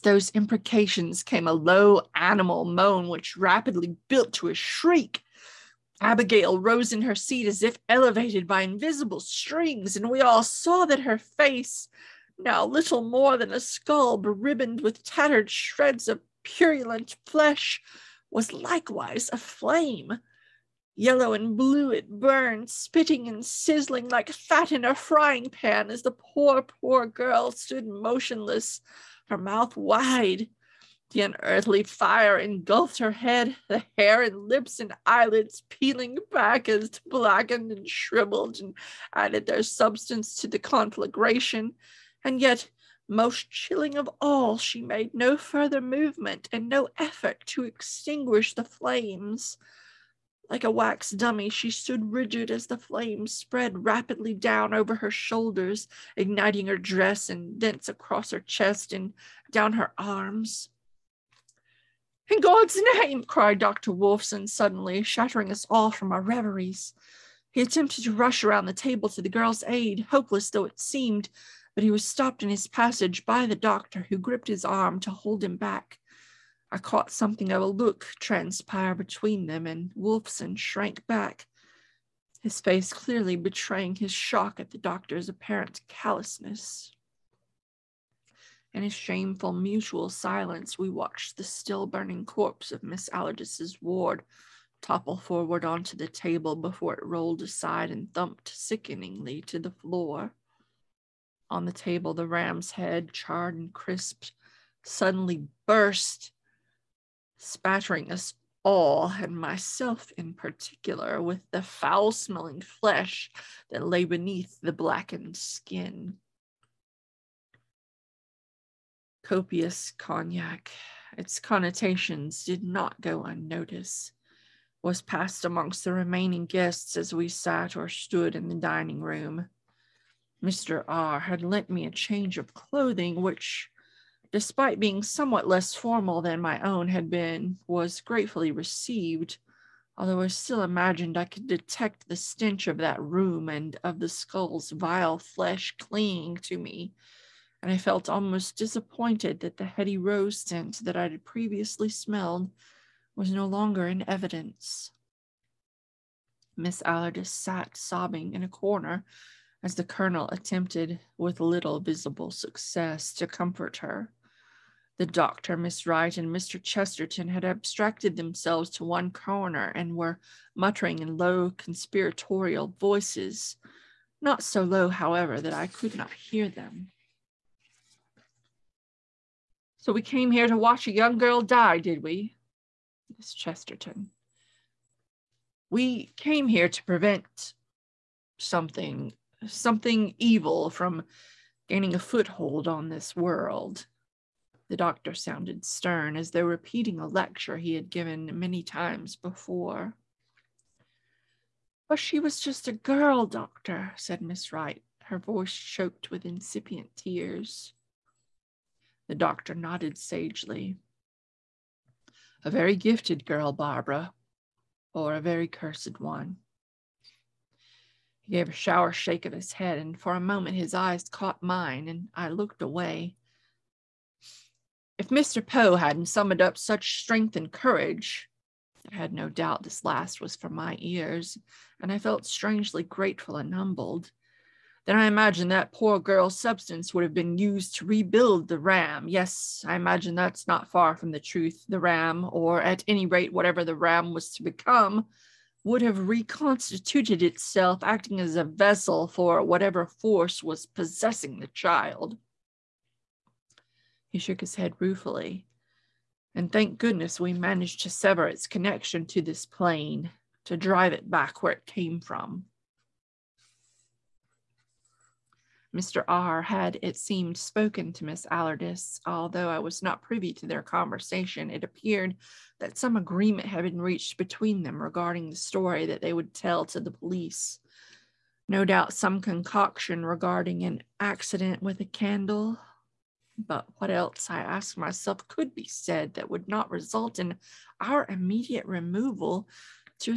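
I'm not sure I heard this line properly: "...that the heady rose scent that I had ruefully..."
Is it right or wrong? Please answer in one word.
wrong.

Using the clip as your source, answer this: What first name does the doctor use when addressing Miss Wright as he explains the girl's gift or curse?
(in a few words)
Barbara.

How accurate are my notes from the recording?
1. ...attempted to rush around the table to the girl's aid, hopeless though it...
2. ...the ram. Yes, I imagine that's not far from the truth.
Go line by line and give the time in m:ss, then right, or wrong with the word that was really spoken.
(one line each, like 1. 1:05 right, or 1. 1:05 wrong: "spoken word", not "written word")
1. 1:07 right
2. 3:58 right.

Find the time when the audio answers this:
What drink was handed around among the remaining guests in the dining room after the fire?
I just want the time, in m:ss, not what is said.
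1:59.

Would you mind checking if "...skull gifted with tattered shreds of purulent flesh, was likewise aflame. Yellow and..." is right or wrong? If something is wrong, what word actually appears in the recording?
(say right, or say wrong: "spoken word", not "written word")
wrong: "beribboned", not "gifted".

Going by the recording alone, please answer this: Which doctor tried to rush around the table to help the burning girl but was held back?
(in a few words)
Dr. Wolfson.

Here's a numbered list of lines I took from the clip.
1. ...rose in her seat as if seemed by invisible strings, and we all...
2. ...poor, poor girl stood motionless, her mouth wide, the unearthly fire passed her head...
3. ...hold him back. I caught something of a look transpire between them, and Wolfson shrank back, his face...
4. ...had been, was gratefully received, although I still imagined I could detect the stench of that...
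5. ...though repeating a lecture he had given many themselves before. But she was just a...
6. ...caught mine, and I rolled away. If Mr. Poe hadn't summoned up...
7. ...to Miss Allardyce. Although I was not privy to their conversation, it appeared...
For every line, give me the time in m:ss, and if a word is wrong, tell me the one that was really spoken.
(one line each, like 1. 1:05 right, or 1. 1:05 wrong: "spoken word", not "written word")
1. 0:06 wrong: "elevated", not "seemed"
2. 0:26 wrong: "engulfed", not "passed"
3. 1:15 right
4. 2:16 right
5. 3:16 wrong: "times", not "themselves"
6. 3:41 wrong: "looked", not "rolled"
7. 4:27 right.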